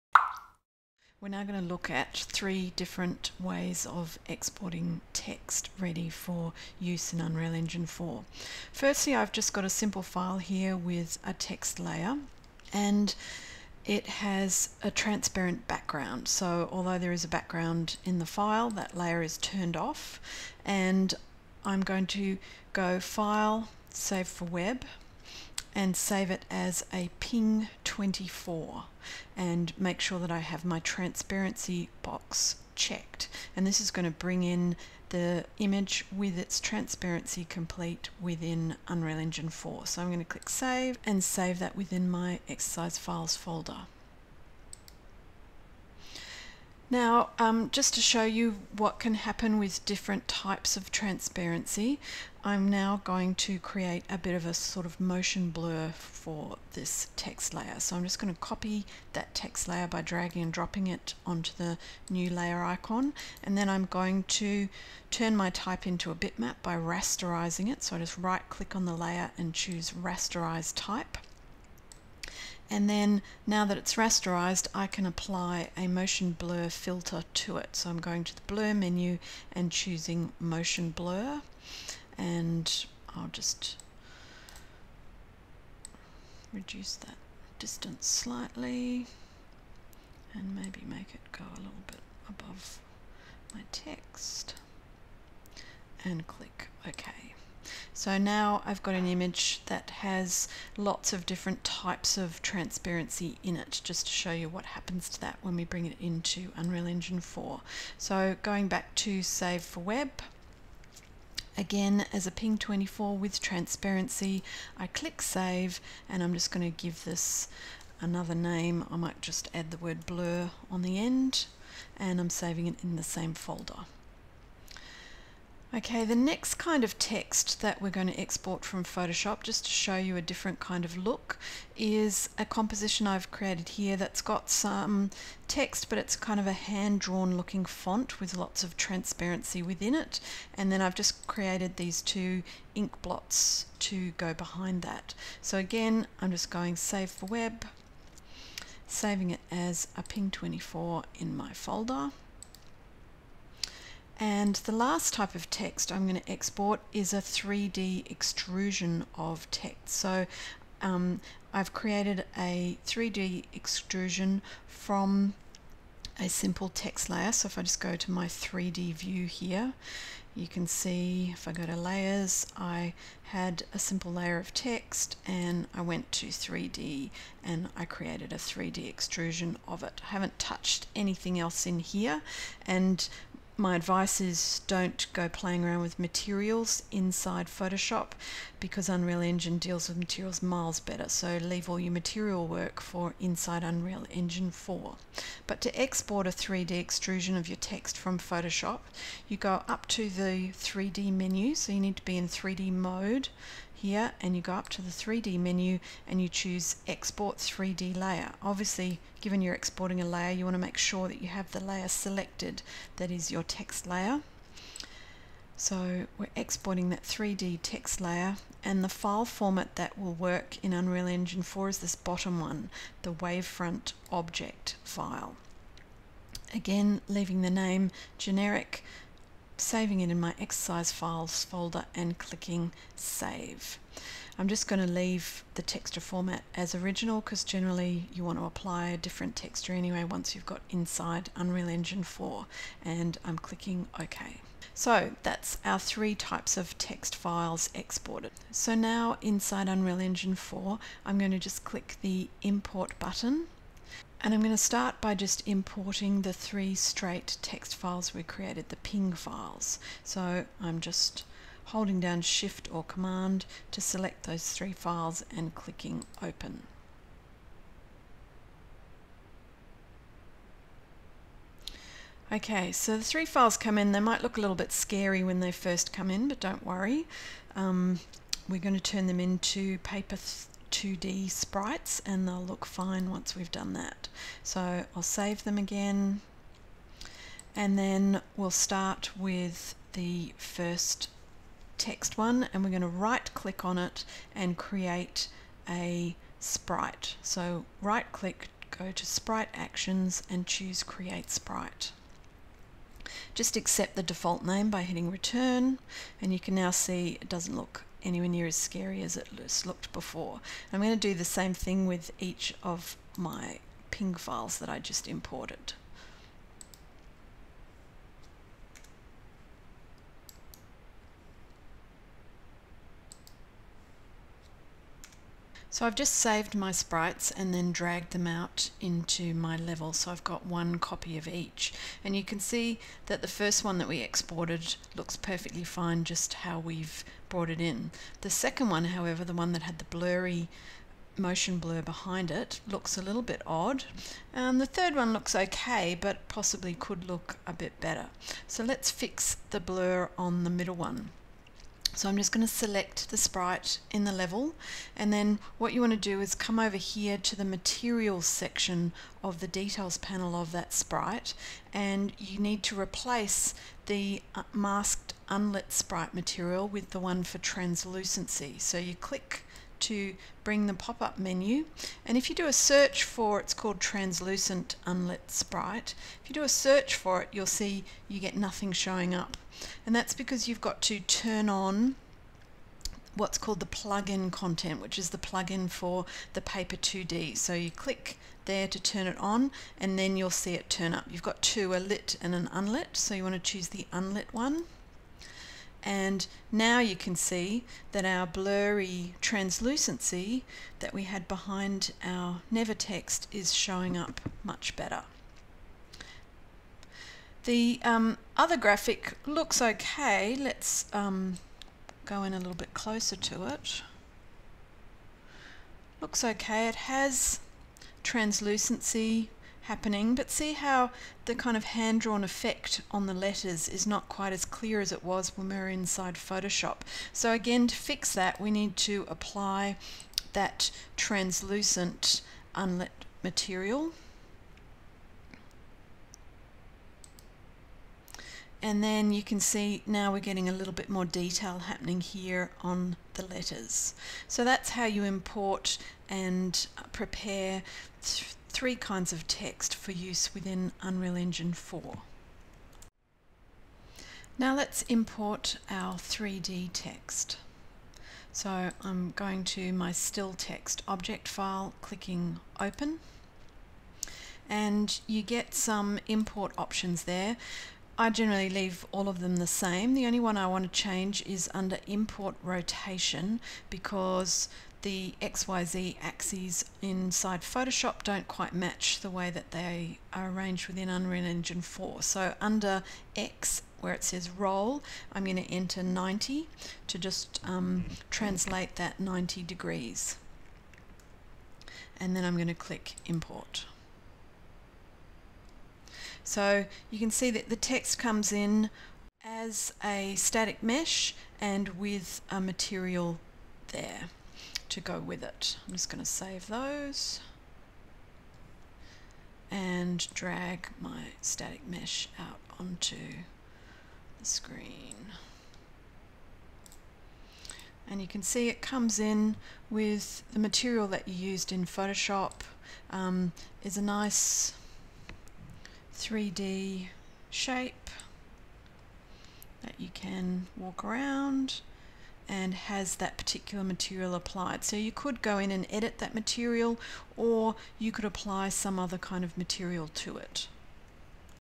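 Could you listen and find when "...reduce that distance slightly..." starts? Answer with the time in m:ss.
1:26.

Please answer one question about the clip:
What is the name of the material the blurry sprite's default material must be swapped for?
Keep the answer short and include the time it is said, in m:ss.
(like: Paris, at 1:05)
translucent unlit sprite, at 6:13.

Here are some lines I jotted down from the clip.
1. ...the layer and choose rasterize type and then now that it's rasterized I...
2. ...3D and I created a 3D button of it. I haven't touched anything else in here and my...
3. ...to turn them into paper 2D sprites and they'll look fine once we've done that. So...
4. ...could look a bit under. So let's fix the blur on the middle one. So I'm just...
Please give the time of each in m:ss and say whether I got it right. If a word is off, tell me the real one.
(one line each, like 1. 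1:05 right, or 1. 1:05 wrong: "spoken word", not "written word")
1. 1:08 right
2. 2:56 wrong: "extrusion", not "button"
3. 4:38 right
4. 5:46 wrong: "better", not "under".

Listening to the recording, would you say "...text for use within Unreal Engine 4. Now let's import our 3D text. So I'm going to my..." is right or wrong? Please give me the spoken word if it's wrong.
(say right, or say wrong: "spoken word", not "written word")
right.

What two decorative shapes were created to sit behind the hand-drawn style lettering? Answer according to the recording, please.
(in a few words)
ink blots.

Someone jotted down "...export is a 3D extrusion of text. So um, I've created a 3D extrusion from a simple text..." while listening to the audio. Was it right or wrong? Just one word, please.
right.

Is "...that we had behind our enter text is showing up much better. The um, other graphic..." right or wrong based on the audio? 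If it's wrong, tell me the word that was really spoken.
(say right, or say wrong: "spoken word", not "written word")
wrong: "never", not "enter".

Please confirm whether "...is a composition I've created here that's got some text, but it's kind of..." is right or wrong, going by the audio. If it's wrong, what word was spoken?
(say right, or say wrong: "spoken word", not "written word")
right.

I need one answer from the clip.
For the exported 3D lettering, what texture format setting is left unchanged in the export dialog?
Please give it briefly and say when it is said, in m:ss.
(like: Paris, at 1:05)
original, at 3:56.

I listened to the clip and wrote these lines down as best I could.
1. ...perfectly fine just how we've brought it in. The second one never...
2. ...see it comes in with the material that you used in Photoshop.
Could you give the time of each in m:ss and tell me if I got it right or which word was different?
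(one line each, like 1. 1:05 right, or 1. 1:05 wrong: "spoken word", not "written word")
1. 5:35 wrong: "however", not "never"
2. 8:38 right.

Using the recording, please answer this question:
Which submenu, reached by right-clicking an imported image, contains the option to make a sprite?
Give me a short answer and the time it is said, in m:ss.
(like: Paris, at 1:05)
sprite actions, at 4:59.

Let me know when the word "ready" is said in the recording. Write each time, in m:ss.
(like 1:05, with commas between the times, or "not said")
0:05.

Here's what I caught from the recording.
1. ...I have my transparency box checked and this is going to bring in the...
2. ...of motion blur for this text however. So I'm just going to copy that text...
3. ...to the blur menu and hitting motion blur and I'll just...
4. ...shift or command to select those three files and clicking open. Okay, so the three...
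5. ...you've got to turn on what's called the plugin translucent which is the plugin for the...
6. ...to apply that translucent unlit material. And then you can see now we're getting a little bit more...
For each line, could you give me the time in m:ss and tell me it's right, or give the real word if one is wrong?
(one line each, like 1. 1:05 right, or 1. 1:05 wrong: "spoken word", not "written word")
1. 0:30 right
2. 0:54 wrong: "layer", not "however"
3. 1:18 wrong: "choosing", not "hitting"
4. 4:22 right
5. 6:20 wrong: "content", not "translucent"
6. 7:08 right.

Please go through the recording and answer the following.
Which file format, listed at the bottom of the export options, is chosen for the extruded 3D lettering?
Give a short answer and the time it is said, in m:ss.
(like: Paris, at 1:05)
wavefront object file, at 3:43.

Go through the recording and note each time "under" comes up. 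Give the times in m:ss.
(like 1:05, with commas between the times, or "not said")
7:51, 8:02.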